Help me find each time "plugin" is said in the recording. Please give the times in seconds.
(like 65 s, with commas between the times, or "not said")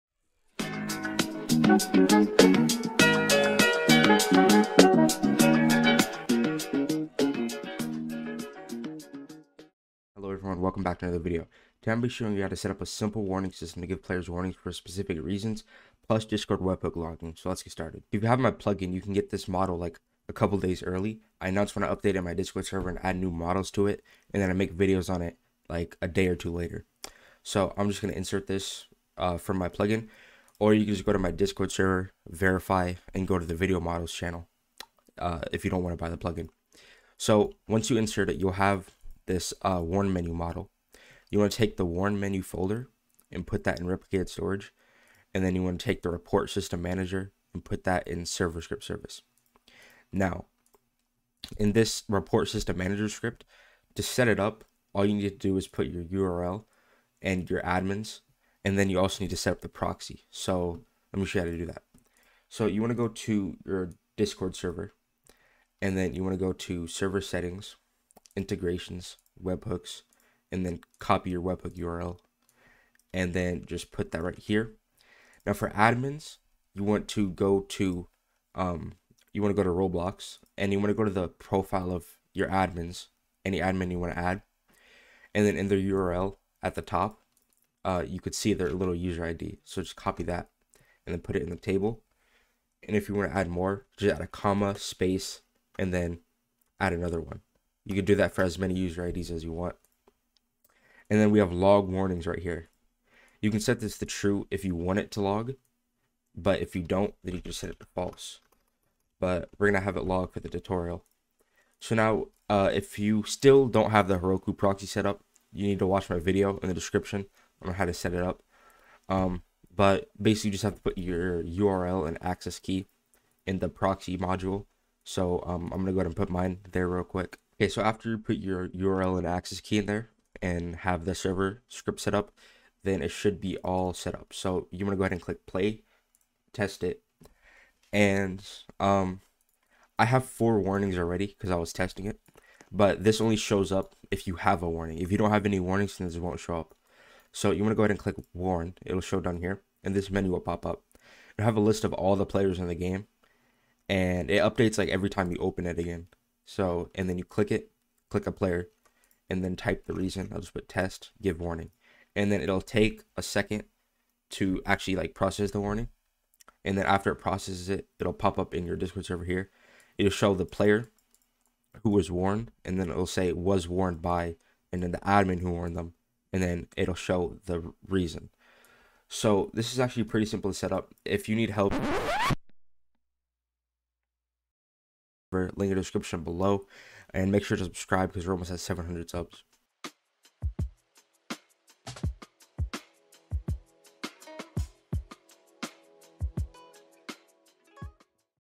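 18 s, 29 s, 36 s.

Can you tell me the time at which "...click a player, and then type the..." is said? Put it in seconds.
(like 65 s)
158 s.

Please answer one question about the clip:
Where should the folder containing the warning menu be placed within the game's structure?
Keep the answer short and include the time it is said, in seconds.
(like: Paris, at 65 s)
Replicated storage, at 43 s.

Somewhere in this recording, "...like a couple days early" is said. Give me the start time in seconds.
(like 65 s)
19 s.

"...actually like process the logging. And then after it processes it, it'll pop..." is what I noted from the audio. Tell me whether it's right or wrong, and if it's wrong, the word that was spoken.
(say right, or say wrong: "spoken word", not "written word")
wrong: "warning", not "logging".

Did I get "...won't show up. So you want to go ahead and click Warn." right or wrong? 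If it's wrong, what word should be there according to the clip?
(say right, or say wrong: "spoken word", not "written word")
right.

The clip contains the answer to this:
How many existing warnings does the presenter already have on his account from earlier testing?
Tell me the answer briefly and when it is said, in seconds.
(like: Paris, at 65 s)
4, at 140 s.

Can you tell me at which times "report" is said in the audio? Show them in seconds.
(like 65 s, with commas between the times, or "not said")
46 s, 52 s.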